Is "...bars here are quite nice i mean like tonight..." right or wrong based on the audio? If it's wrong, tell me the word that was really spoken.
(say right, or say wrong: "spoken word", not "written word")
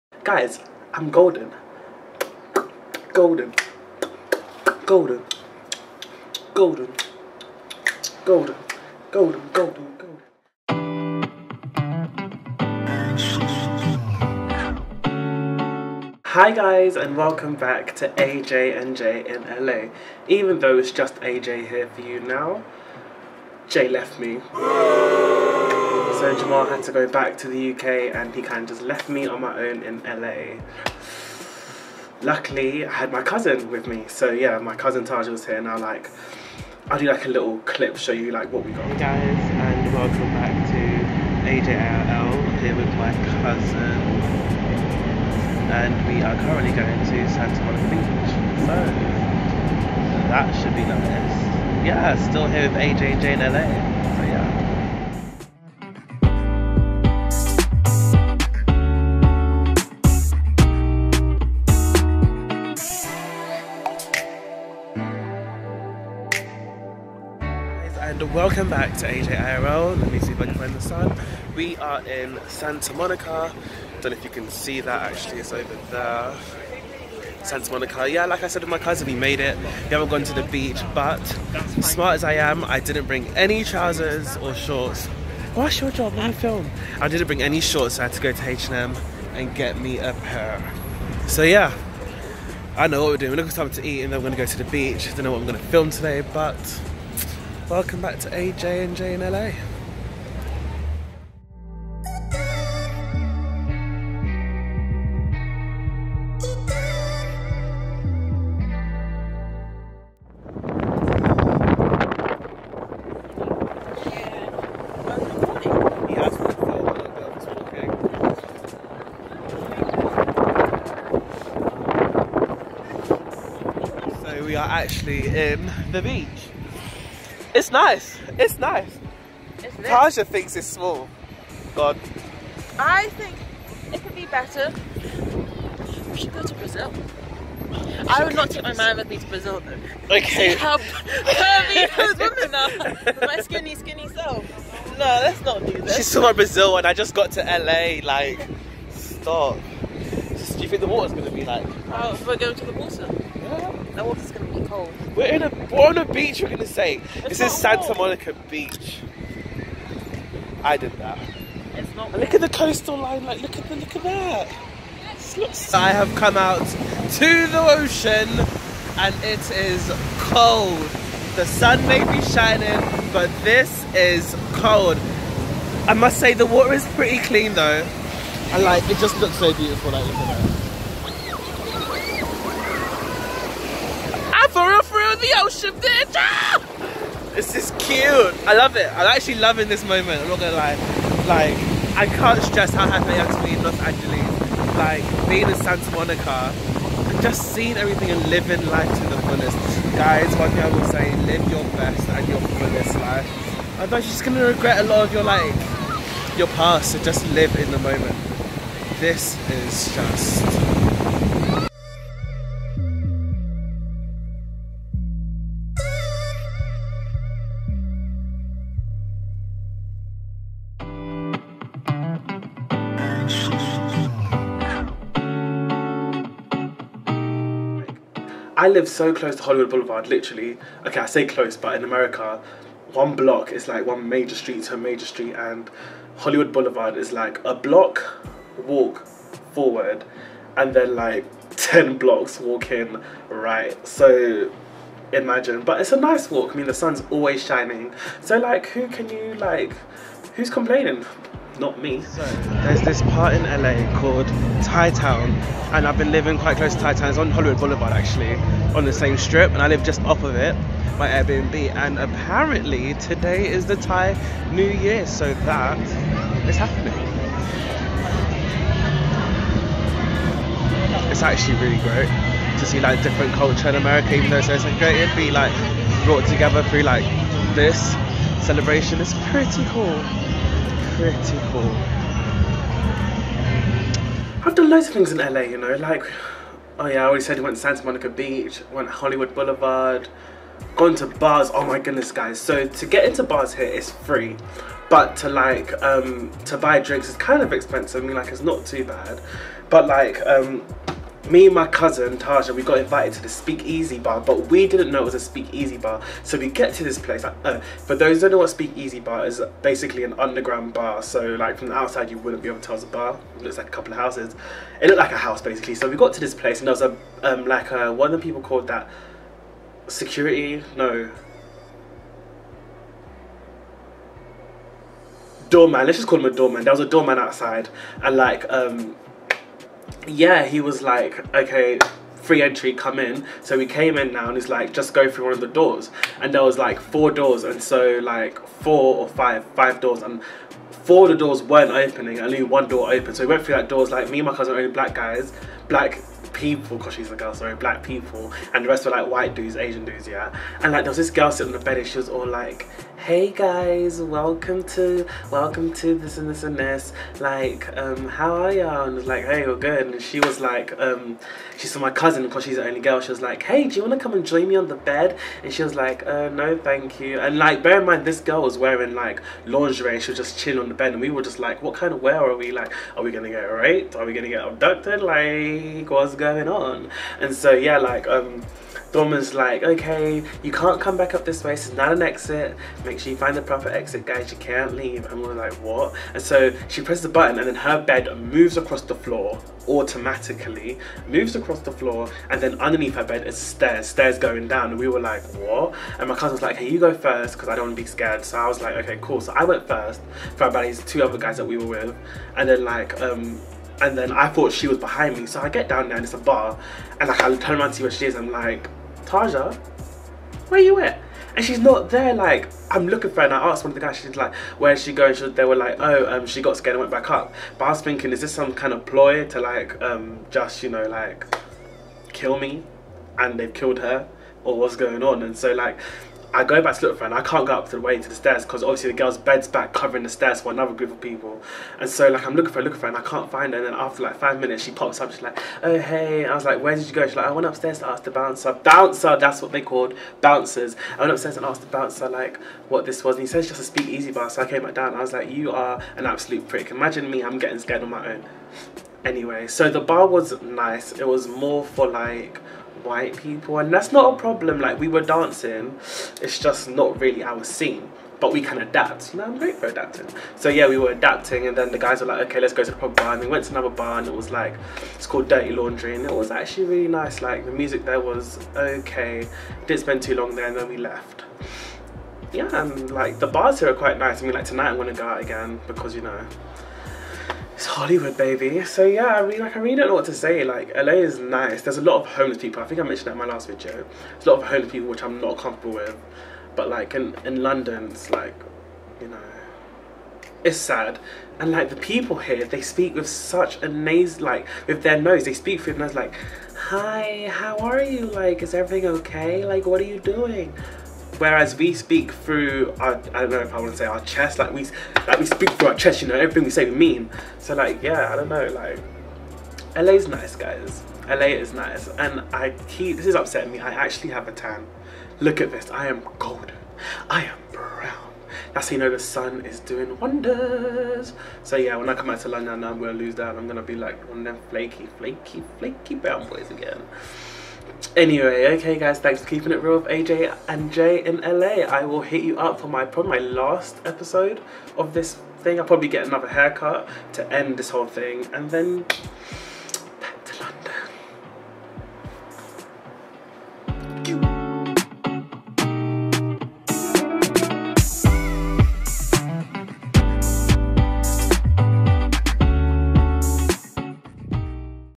right.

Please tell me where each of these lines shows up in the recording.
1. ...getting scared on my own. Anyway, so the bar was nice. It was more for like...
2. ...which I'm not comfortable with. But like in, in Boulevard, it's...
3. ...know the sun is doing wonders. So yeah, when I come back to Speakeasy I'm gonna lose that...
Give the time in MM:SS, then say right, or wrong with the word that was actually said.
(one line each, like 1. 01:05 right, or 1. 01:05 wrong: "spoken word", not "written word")
1. 07:27 right
2. 08:04 wrong: "London", not "Boulevard"
3. 08:38 wrong: "London", not "Speakeasy".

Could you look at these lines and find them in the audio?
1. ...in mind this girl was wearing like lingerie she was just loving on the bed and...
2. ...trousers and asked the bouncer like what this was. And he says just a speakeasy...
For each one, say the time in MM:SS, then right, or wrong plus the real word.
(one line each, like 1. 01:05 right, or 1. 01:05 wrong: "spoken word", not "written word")
1. 06:07 wrong: "chilling", not "loving"
2. 07:21 wrong: "upstairs", not "trousers".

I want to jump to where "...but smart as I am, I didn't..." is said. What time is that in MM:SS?
01:20.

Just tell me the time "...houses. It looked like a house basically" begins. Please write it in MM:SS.
05:13.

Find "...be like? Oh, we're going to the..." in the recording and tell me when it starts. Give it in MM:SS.
02:31.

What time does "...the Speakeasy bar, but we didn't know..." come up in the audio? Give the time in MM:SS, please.
05:03.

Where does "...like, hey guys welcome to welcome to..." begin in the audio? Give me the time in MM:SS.
05:52.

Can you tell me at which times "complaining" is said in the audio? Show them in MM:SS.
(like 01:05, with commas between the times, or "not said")
04:10.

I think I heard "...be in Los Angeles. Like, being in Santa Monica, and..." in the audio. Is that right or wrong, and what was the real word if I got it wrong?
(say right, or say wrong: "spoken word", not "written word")
right.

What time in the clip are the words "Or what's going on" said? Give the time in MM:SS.
07:04.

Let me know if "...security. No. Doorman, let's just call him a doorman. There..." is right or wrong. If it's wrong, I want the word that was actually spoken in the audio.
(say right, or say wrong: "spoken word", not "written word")
right.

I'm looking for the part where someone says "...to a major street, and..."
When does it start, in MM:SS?
03:54.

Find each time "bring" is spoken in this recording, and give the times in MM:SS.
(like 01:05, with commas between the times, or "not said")
01:23, 01:27.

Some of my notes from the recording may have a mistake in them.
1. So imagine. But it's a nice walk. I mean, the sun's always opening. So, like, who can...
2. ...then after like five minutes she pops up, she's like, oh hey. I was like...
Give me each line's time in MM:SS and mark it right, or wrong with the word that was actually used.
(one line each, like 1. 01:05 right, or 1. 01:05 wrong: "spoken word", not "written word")
1. 04:03 wrong: "shining", not "opening"
2. 07:13 right.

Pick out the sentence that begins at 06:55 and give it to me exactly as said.
She, they were like, oh, um, she got scared and went back up.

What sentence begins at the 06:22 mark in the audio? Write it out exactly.
Make sure you find the proper exit, guys, you can't leave.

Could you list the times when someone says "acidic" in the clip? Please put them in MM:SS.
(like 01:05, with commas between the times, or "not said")
not said.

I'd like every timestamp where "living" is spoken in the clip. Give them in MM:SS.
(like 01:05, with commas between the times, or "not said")
03:18, 04:16.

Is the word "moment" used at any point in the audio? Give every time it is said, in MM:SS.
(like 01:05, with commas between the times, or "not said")
03:09, 03:27.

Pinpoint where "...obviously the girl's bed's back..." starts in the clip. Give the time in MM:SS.
07:08.